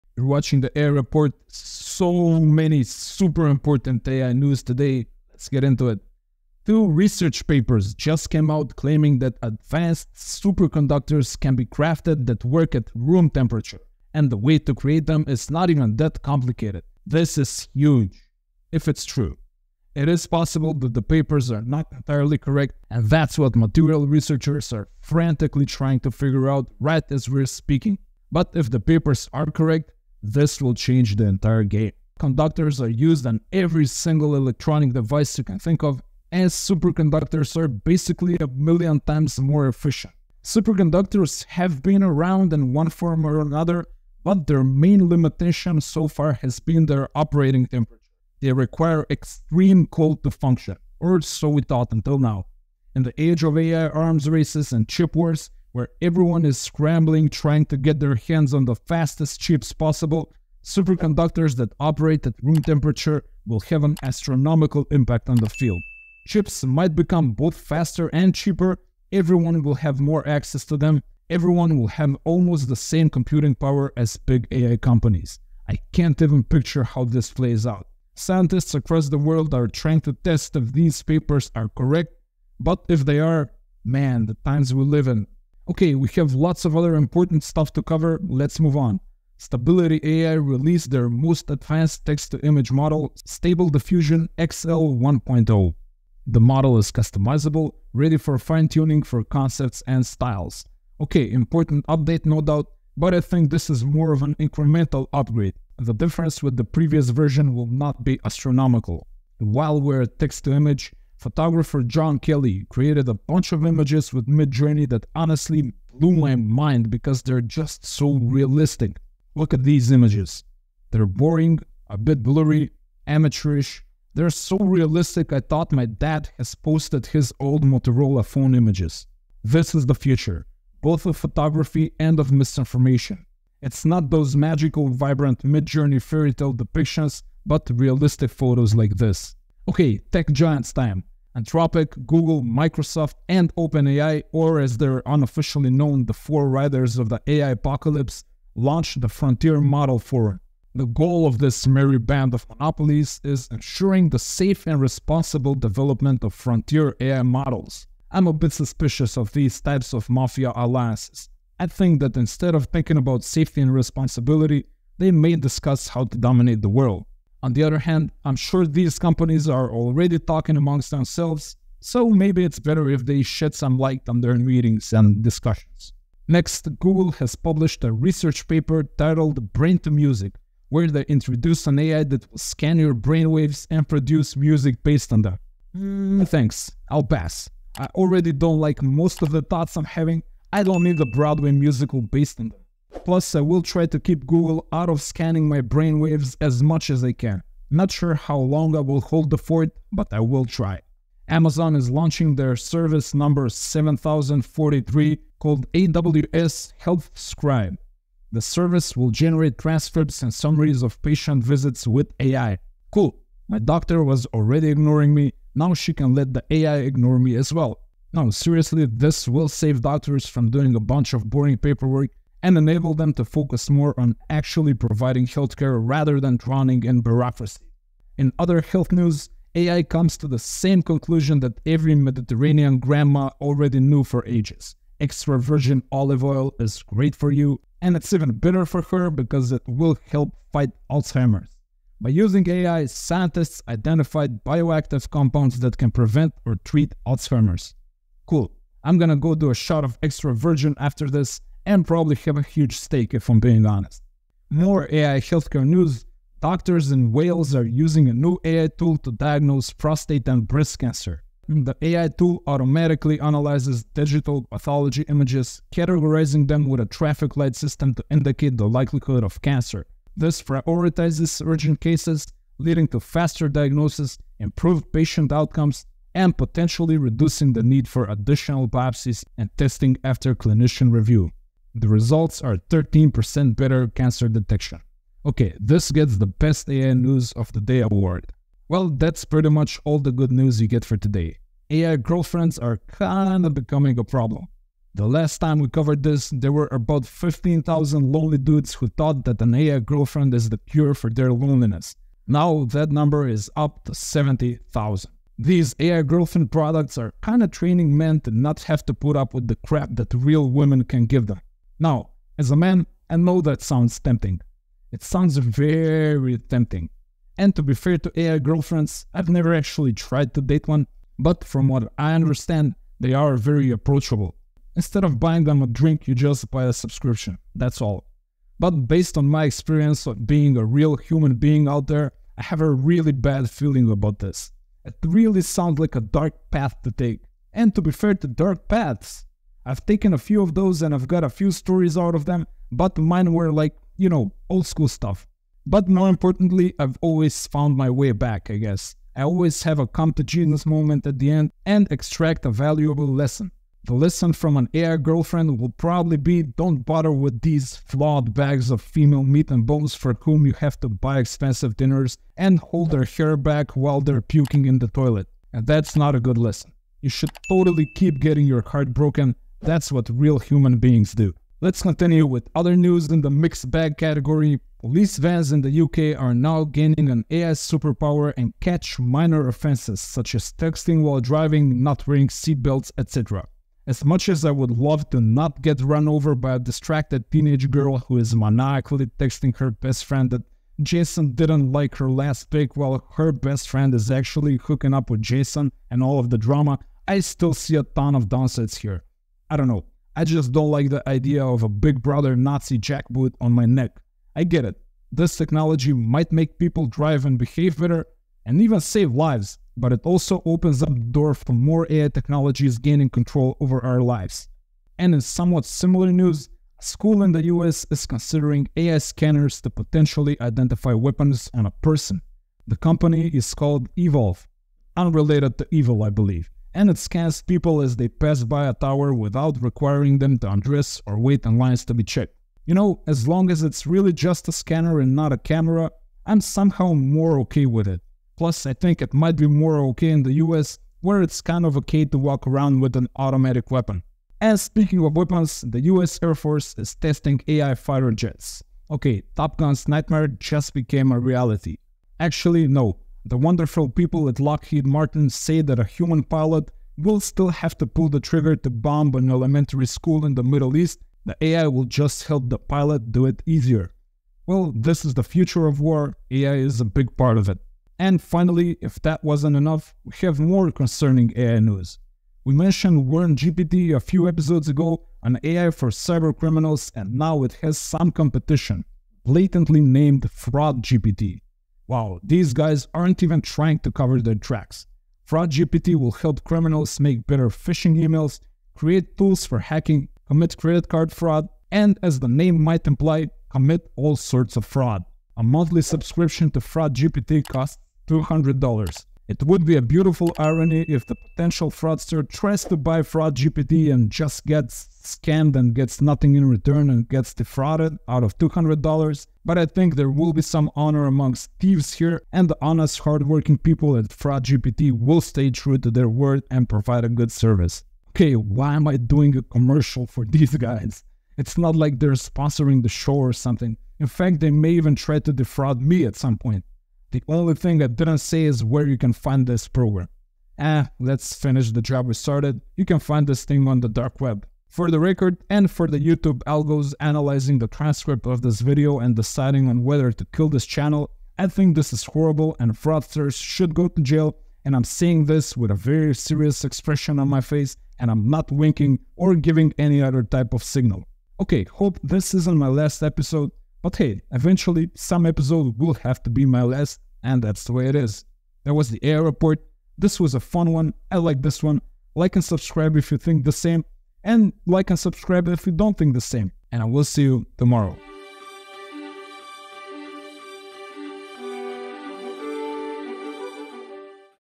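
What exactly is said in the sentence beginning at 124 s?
They're so realistic, I thought my dad has posted his old Motorola phone images.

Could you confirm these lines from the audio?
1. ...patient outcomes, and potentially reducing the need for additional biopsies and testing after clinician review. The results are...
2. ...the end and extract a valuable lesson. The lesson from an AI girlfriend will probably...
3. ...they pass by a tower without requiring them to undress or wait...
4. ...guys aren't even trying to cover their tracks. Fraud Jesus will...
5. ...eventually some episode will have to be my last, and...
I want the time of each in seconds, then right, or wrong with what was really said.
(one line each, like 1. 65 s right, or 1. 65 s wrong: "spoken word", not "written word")
1. 274 s right
2. 351 s right
3. 427 s right
4. 482 s wrong: "GPT", not "Jesus"
5. 554 s right.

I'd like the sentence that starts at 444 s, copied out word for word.
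And speaking of weapons, the US Air Force is testing AI fighter jets.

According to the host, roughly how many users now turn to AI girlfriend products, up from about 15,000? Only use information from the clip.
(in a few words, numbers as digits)
70,000.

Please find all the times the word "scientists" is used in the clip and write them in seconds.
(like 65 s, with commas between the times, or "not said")
78 s, 242 s.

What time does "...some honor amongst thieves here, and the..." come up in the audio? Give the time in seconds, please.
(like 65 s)
510 s.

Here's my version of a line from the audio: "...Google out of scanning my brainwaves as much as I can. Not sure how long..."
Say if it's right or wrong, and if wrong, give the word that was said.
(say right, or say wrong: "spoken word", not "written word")
right.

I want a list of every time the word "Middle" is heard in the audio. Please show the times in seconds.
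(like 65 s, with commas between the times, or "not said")
460 s.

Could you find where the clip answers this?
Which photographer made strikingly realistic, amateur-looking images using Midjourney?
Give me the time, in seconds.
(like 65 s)
111 s.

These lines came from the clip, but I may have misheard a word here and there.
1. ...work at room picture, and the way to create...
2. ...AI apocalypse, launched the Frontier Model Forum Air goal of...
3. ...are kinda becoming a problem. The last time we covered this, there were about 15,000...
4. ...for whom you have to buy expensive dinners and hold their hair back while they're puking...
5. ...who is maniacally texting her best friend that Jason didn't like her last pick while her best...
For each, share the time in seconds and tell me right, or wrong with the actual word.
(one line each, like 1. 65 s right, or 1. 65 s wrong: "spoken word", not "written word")
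1. 12 s wrong: "temperature", not "picture"
2. 147 s wrong: "The", not "Air"
3. 292 s right
4. 359 s right
5. 387 s right.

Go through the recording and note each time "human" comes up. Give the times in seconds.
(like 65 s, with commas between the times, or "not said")
330 s, 370 s, 455 s.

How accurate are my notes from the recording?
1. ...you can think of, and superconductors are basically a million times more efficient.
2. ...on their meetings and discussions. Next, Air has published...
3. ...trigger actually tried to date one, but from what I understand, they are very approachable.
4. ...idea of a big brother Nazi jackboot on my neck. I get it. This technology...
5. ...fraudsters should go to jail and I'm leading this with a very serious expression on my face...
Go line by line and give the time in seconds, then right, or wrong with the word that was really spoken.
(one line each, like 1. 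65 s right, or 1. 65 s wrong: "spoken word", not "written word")
1. 35 s right
2. 174 s wrong: "Google", not "Air"
3. 319 s wrong: "never", not "trigger"
4. 401 s right
5. 542 s wrong: "saying", not "leading".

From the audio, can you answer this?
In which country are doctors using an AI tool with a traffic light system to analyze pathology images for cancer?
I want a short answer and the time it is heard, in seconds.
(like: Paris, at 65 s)
Wales, at 257 s.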